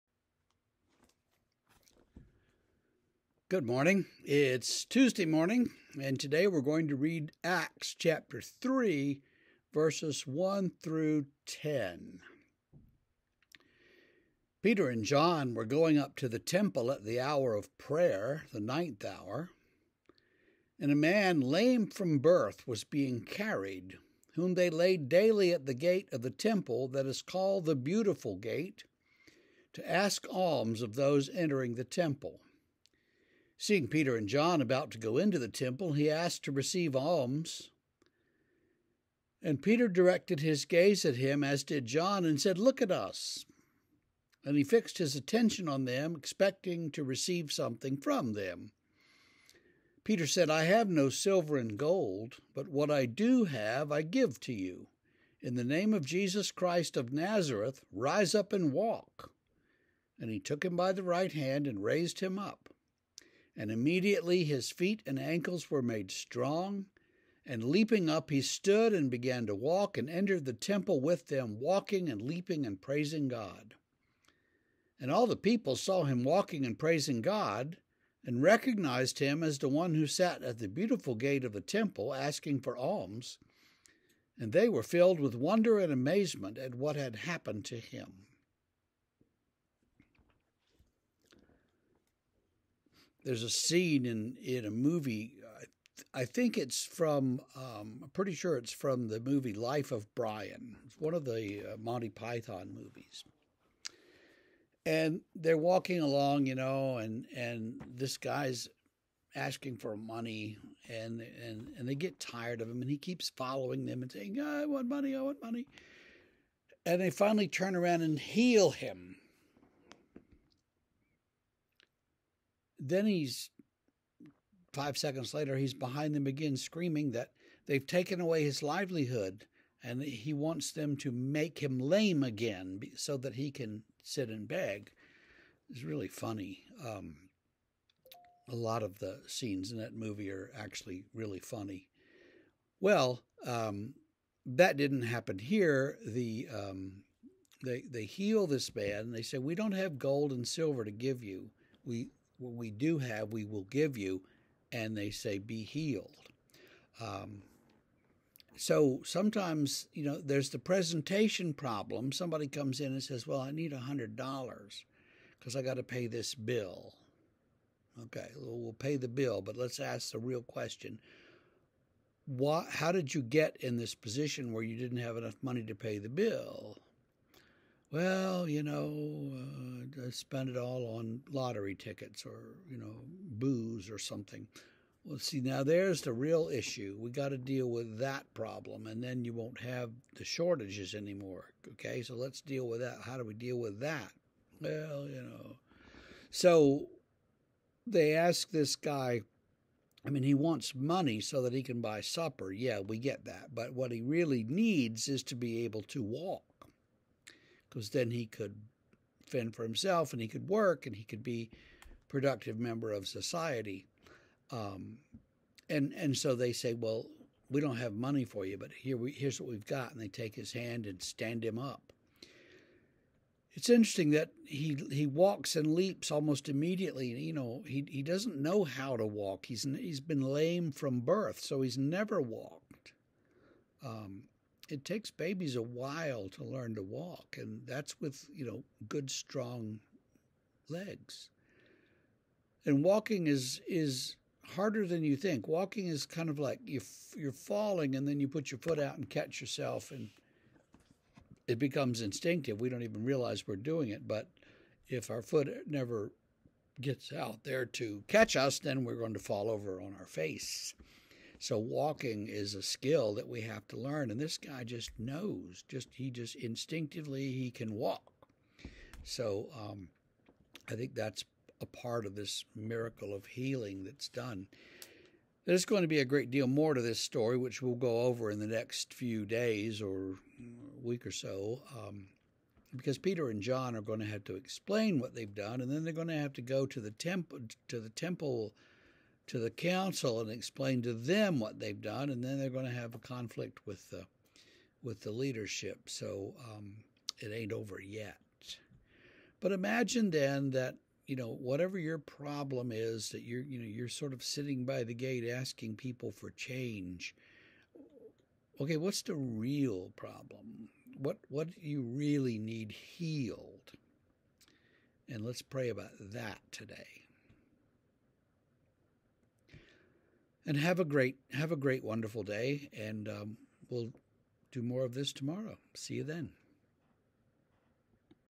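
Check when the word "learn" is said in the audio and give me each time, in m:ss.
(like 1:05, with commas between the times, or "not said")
3:56, 4:23.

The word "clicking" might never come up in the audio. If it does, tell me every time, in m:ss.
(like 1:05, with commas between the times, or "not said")
not said.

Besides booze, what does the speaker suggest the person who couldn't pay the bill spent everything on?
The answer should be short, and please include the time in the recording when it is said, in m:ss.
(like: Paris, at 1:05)
lottery tickets, at 3:01.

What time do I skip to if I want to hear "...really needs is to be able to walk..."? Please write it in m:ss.
3:24.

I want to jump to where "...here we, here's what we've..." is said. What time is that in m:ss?
3:38.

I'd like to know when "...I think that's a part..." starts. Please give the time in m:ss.
4:30.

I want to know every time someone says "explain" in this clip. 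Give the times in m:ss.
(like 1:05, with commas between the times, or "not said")
4:44, 4:50.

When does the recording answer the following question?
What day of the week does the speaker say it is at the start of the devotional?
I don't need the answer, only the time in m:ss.
0:04.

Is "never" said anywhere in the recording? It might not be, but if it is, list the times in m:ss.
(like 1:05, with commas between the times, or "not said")
3:51, 4:15.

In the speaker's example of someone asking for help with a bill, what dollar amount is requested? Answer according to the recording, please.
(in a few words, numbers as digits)
$100.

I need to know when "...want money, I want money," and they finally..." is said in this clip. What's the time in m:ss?
1:54.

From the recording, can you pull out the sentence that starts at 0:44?
And he fixed his attention on them, expecting to receive something from them.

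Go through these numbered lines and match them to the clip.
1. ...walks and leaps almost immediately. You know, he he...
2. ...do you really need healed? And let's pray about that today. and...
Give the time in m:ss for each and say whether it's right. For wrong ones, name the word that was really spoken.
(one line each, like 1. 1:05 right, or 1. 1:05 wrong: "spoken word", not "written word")
1. 3:45 right
2. 5:11 right.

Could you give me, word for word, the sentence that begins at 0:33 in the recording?
Seeing Peter and John about to go into the temple, he asked to receive alms.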